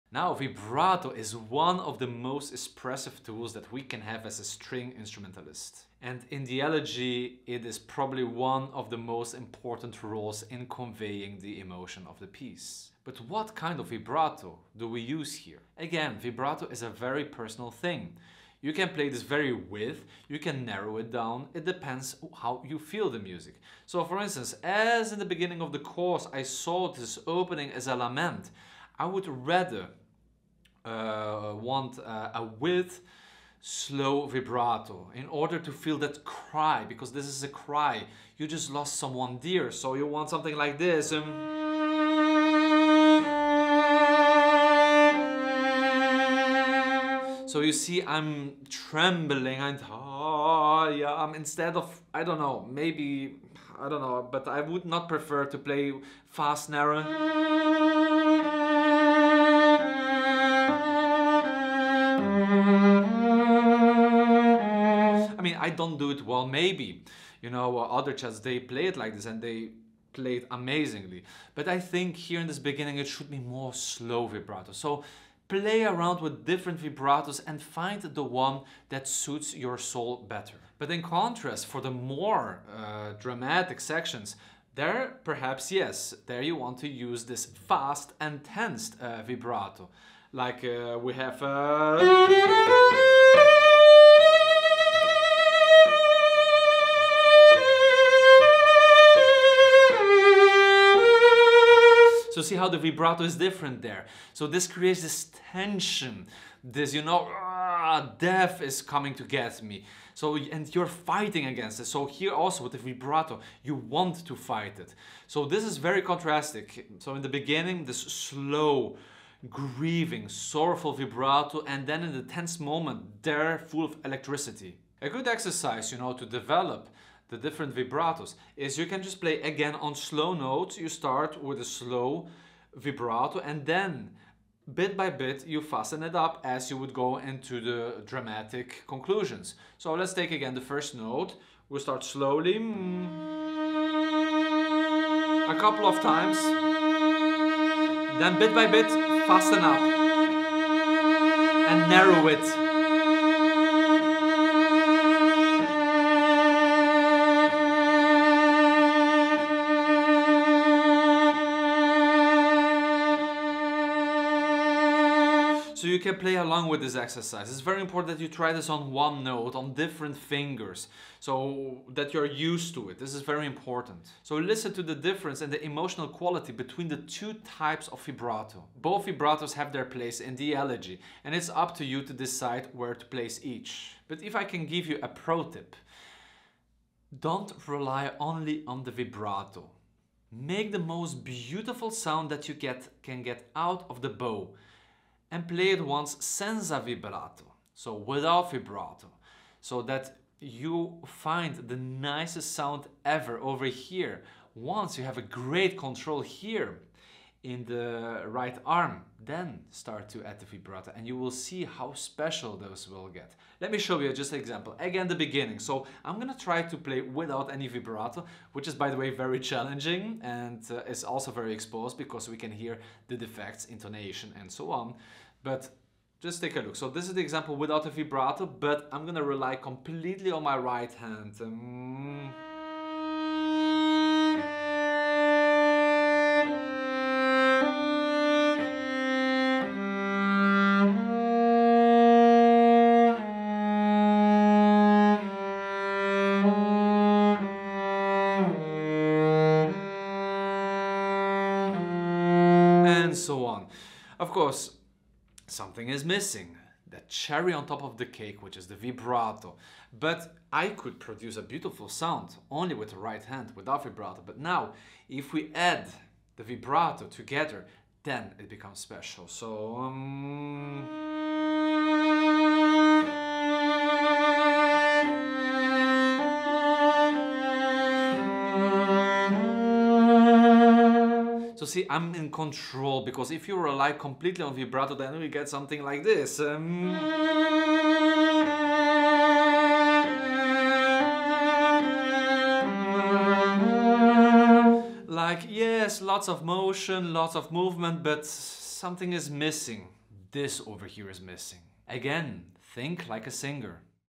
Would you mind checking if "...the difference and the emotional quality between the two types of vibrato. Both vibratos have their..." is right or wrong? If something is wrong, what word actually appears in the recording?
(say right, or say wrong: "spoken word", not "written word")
right.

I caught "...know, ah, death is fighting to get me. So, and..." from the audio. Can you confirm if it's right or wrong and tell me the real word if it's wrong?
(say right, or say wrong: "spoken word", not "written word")
wrong: "coming", not "fighting".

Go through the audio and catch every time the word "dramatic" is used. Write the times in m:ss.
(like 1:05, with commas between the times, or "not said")
1:23, 2:18.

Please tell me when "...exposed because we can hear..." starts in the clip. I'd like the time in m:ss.
3:41.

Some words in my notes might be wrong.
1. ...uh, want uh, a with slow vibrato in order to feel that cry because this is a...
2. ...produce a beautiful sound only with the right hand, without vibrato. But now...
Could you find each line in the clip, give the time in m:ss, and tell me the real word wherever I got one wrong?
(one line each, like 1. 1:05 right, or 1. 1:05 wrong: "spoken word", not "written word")
1. 0:30 right
2. 4:20 right.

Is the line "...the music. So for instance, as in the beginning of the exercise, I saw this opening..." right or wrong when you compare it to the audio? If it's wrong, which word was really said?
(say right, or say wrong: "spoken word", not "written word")
wrong: "course", not "exercise".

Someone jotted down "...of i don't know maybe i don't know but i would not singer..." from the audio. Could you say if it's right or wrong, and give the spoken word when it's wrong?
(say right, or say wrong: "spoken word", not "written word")
wrong: "prefer", not "singer".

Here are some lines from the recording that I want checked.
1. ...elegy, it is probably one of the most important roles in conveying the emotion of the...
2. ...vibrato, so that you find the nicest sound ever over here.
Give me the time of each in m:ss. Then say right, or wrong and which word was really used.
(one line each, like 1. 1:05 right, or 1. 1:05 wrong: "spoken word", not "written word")
1. 0:06 right
2. 3:18 right.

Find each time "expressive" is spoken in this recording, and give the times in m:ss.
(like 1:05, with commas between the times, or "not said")
0:02.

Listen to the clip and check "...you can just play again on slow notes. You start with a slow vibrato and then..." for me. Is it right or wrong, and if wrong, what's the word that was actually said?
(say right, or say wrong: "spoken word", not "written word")
right.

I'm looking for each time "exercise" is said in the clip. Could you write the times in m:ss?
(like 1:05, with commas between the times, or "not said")
2:05, 2:46.